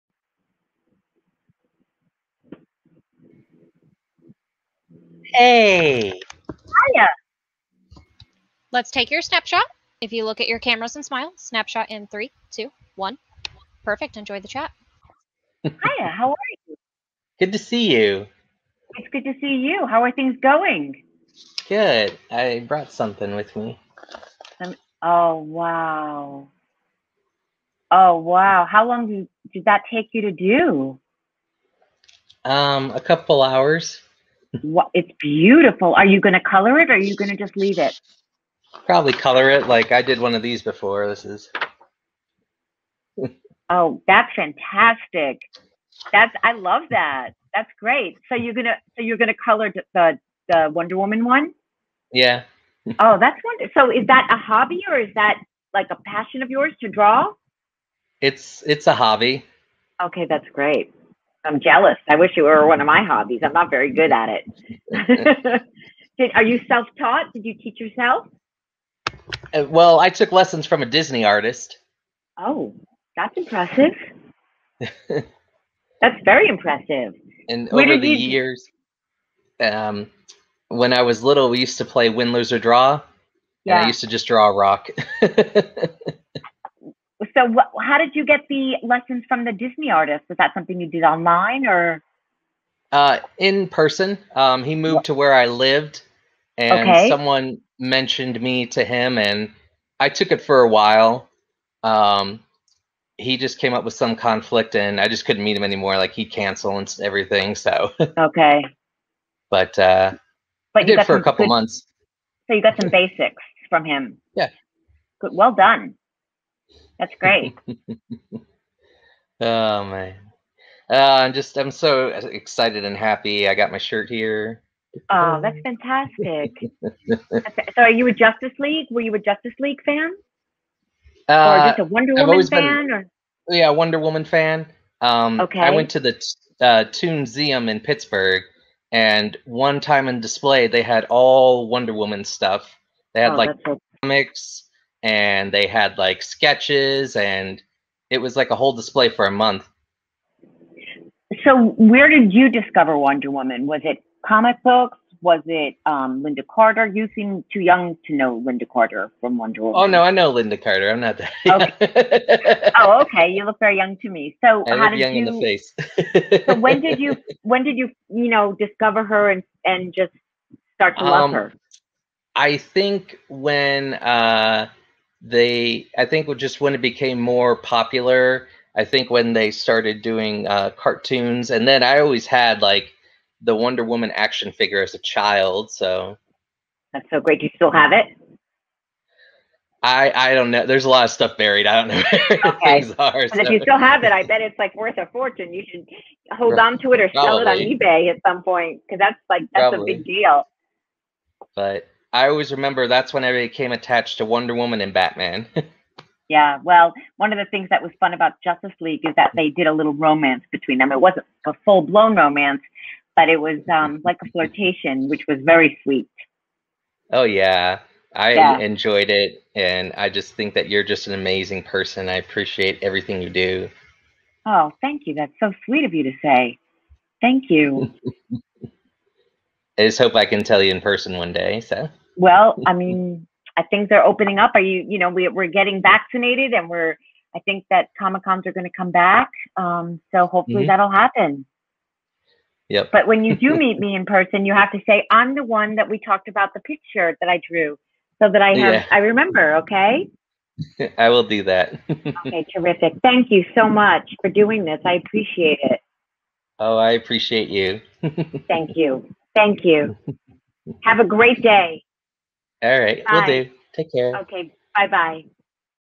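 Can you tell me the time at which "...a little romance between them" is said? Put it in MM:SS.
03:29.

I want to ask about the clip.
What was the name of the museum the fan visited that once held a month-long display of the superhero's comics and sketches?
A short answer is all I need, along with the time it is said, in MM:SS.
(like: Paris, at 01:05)
Toonseum, at 02:16.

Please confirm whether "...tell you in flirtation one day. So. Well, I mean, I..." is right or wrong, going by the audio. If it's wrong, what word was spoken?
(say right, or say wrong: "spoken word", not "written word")
wrong: "person", not "flirtation".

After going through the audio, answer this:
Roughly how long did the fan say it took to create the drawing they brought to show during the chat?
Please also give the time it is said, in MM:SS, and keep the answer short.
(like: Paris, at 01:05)
A couple hours, at 00:32.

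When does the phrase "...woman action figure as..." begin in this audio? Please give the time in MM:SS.
03:03.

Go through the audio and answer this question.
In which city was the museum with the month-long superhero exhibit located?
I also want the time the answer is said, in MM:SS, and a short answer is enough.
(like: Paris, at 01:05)
Pittsburgh, at 02:17.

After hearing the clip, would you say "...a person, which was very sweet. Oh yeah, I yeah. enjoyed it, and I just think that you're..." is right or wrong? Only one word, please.
wrong.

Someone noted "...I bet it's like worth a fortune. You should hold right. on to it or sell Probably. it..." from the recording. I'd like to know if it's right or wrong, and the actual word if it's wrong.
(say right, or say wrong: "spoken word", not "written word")
right.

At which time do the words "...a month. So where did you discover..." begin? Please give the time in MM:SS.
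02:29.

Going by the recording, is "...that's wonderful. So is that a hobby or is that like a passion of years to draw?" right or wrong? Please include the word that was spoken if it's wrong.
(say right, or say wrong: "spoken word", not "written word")
wrong: "yours", not "years".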